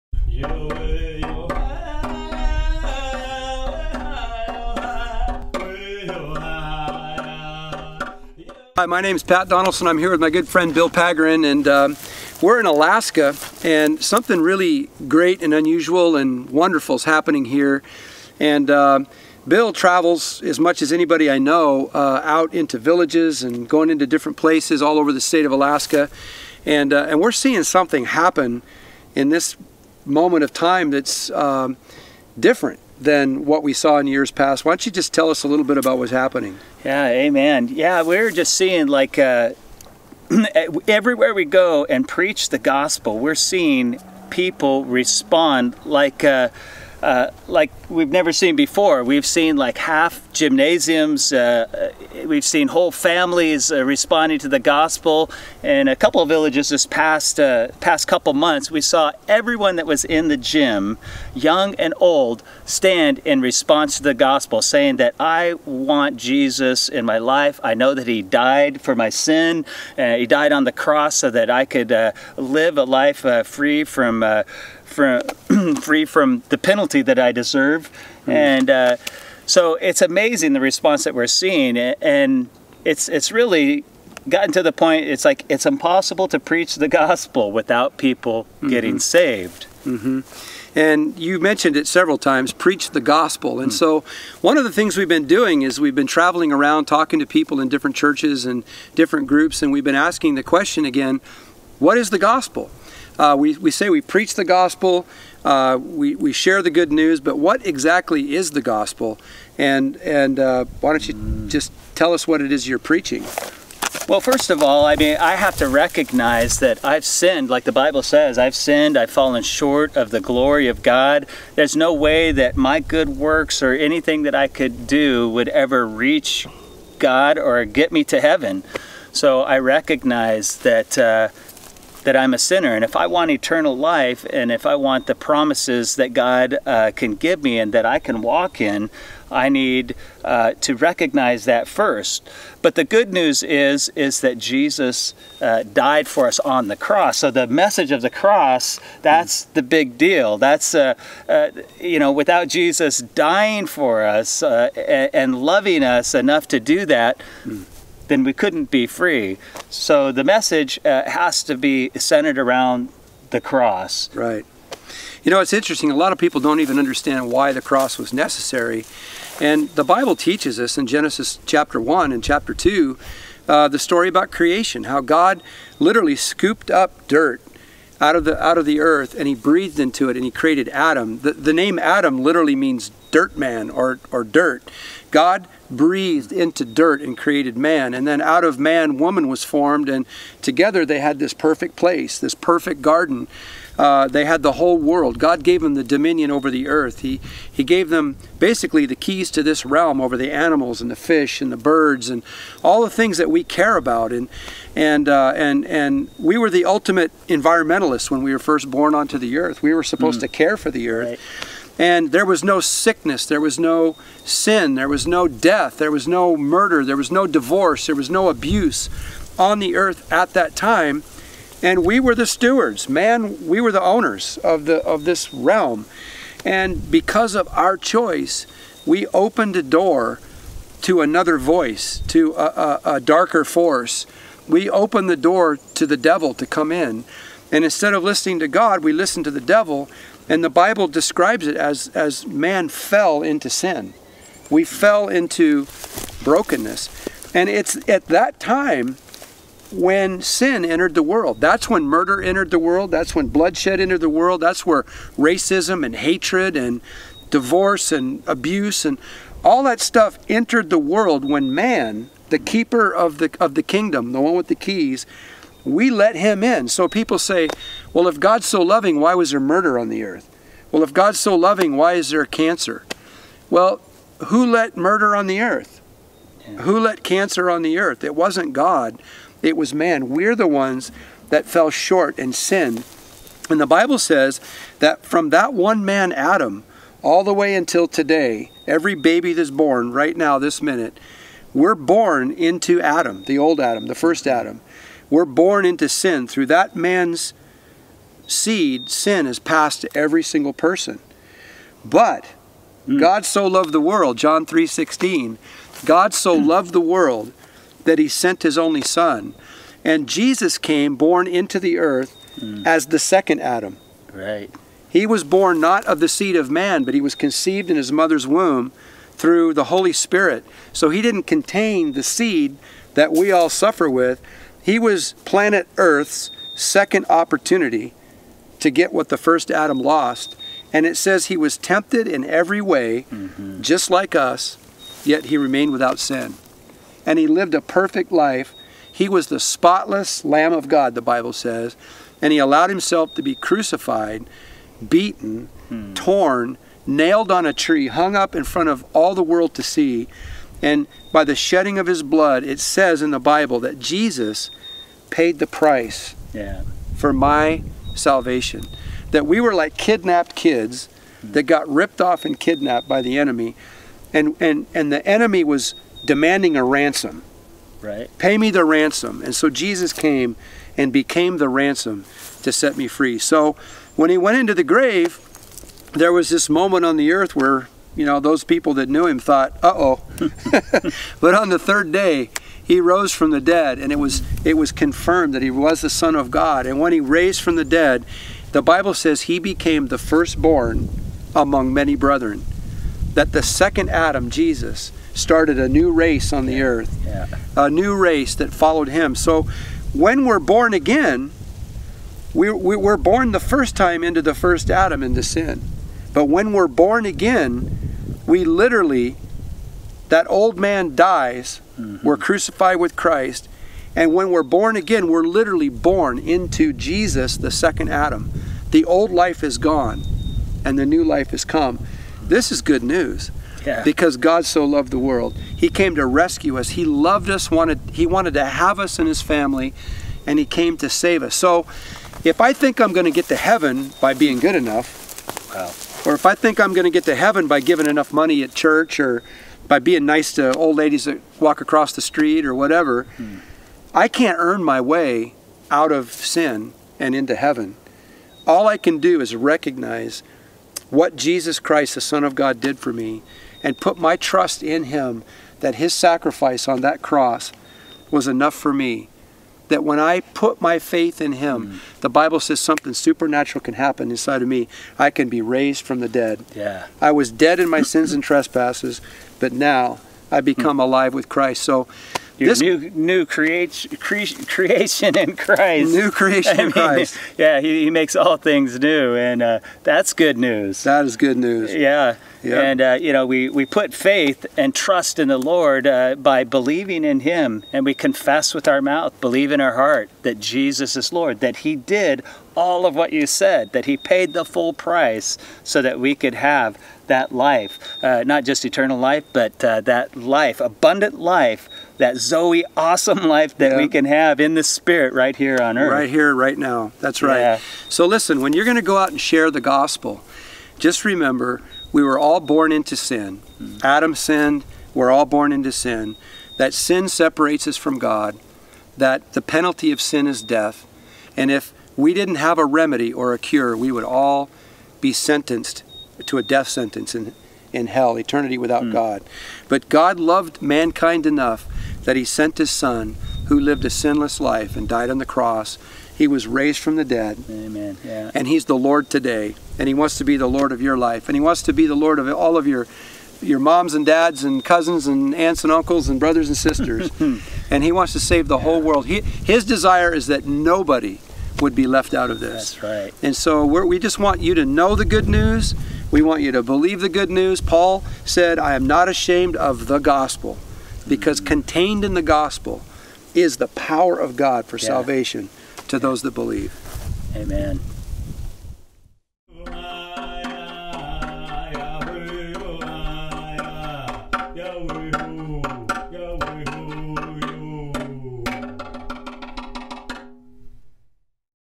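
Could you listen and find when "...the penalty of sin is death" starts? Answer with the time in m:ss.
8:39.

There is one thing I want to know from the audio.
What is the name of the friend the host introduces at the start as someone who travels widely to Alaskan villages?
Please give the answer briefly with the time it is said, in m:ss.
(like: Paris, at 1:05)
Bill Pagaran, at 0:10.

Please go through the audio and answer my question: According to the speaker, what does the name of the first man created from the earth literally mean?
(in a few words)
Dirt man.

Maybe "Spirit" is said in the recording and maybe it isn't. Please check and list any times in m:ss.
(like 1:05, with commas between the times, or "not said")
5:19, 8:24.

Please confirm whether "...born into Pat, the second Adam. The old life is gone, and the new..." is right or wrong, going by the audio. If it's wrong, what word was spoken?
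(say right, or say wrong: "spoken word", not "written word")
wrong: "Jesus", not "Pat".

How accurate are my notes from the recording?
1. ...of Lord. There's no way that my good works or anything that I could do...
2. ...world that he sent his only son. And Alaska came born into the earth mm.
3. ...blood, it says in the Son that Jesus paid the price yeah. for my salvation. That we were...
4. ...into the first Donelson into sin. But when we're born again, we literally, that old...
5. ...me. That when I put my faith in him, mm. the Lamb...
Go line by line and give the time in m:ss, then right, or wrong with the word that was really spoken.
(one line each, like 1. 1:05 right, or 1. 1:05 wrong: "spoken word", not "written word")
1. 2:00 wrong: "God", not "Lord"
2. 5:06 wrong: "Jesus", not "Alaska"
3. 5:52 wrong: "Bible", not "Son"
4. 6:44 wrong: "Adam", not "Donelson"
5. 7:38 wrong: "Bible", not "Lamb".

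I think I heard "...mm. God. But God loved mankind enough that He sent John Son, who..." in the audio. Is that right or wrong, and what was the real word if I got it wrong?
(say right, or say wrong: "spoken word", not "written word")
wrong: "His", not "John".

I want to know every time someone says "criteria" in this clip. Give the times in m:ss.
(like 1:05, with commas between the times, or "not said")
not said.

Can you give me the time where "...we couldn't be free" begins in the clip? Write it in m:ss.
2:38.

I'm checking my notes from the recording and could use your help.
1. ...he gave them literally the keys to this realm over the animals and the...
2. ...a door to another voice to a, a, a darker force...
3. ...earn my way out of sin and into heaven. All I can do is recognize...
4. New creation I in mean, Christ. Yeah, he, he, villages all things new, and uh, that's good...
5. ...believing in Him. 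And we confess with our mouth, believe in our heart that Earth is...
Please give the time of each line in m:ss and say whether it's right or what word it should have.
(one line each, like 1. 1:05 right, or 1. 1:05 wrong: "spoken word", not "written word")
1. 3:17 wrong: "basically", not "literally"
2. 3:49 right
3. 7:24 right
4. 7:55 wrong: "makes", not "villages"
5. 8:06 wrong: "Jesus", not "Earth".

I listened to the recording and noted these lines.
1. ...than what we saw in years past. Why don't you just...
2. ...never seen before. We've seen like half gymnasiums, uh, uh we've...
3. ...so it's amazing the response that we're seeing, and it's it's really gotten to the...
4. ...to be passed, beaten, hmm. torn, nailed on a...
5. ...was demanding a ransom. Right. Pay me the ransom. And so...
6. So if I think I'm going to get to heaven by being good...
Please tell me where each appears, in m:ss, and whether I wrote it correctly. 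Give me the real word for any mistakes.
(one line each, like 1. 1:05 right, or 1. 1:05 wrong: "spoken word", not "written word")
1. 0:32 right
2. 0:48 right
3. 1:19 right
4. 5:43 wrong: "crucified", not "passed"
5. 6:05 right
6. 7:11 right.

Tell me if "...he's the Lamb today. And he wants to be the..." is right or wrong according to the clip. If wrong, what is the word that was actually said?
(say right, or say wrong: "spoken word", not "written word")
wrong: "Lord", not "Lamb".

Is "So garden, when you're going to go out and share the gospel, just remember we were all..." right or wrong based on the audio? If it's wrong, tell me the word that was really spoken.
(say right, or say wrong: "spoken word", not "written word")
wrong: "listen", not "garden".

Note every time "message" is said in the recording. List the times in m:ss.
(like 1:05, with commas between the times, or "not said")
2:27, 2:40.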